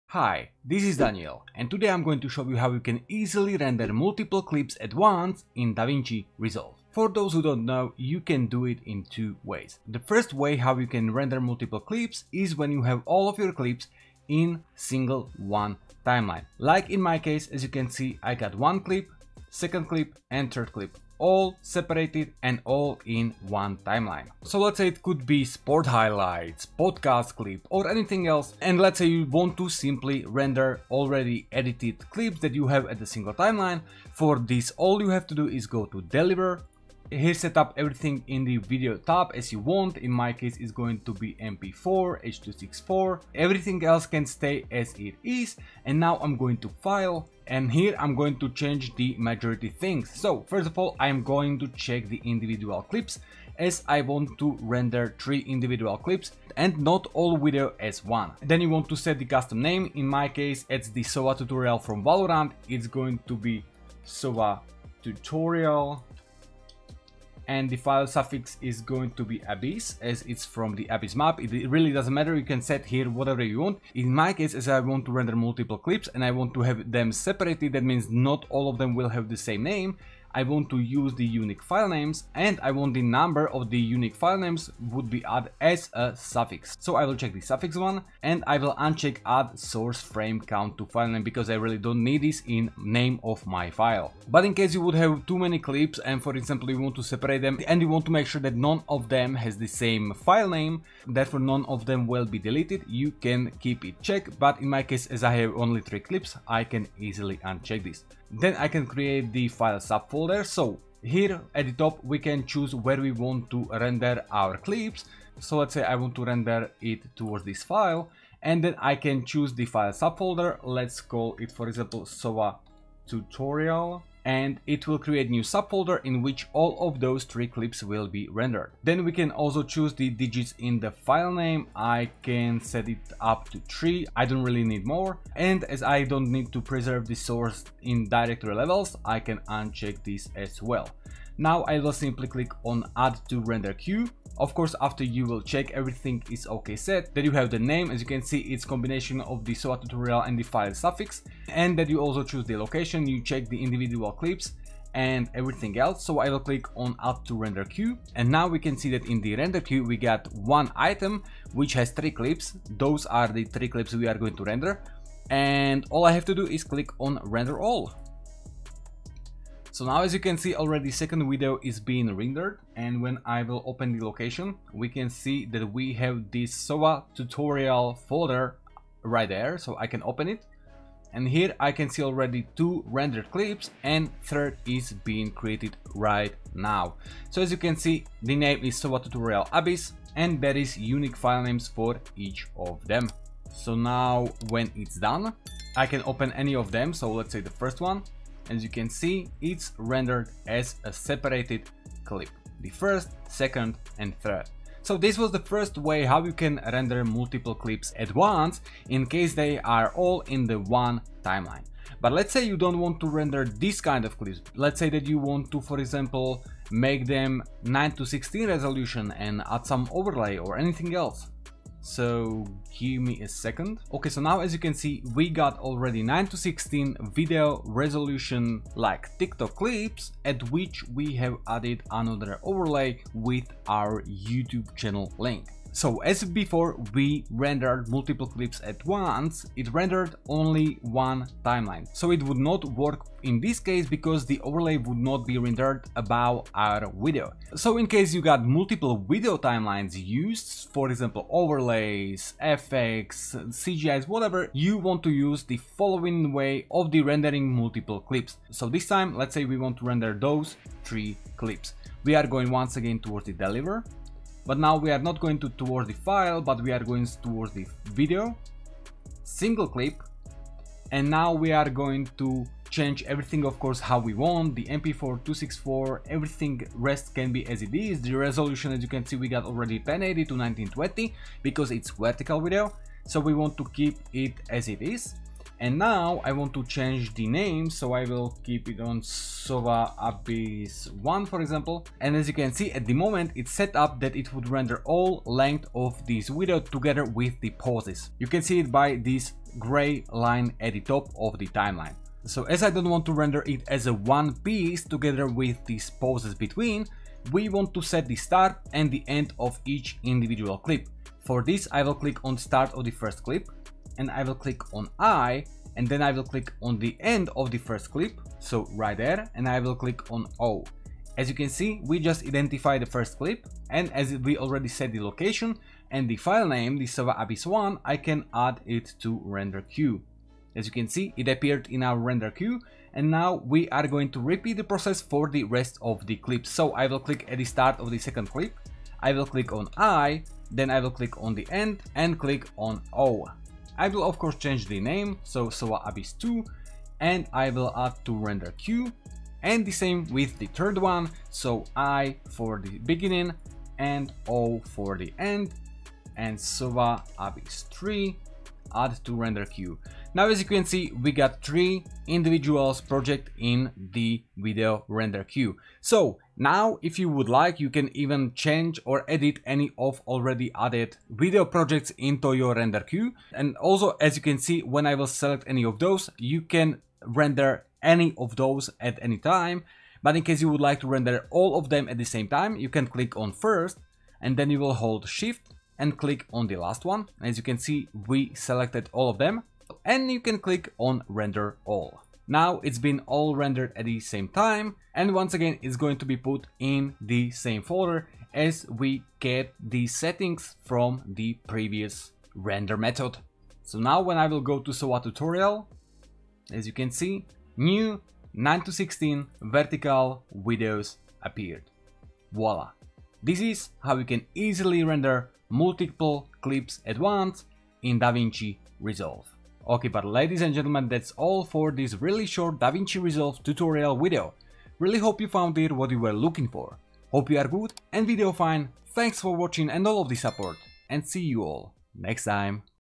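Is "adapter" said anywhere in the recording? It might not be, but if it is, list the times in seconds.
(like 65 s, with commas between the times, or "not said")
not said.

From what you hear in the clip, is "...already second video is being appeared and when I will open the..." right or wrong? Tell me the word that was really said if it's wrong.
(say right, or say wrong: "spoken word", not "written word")
wrong: "rendered", not "appeared".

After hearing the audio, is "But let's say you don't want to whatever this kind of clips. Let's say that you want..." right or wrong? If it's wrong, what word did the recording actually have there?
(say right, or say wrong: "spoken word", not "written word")
wrong: "render", not "whatever".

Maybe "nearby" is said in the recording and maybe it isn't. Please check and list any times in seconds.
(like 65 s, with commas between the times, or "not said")
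not said.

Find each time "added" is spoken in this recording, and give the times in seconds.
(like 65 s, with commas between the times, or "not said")
85 s, 231 s, 370 s.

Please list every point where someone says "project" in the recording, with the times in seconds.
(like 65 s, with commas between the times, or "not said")
362 s, 371 s.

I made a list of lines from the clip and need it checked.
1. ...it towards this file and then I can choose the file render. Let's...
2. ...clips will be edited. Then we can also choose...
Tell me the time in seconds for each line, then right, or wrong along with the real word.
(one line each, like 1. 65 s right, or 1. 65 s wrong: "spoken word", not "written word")
1. 116 s wrong: "subfolder", not "render"
2. 127 s wrong: "rendered", not "edited".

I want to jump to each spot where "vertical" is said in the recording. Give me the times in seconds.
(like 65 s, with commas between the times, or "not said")
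281 s, 409 s.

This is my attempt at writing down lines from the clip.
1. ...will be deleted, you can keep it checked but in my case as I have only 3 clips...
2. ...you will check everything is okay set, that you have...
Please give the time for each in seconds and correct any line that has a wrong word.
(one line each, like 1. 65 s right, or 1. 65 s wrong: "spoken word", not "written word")
1. 102 s right
2. 145 s right.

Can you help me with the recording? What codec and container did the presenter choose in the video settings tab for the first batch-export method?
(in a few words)
MP4 H264.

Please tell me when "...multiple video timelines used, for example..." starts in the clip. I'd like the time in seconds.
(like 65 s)
248 s.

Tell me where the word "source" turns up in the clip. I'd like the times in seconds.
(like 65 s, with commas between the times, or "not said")
89 s, 137 s.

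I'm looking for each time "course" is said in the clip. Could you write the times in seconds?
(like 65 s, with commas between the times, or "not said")
144 s, 273 s, 344 s.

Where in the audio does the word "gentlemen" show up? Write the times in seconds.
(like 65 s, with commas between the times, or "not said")
420 s.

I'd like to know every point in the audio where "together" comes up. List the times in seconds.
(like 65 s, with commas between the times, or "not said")
296 s, 304 s.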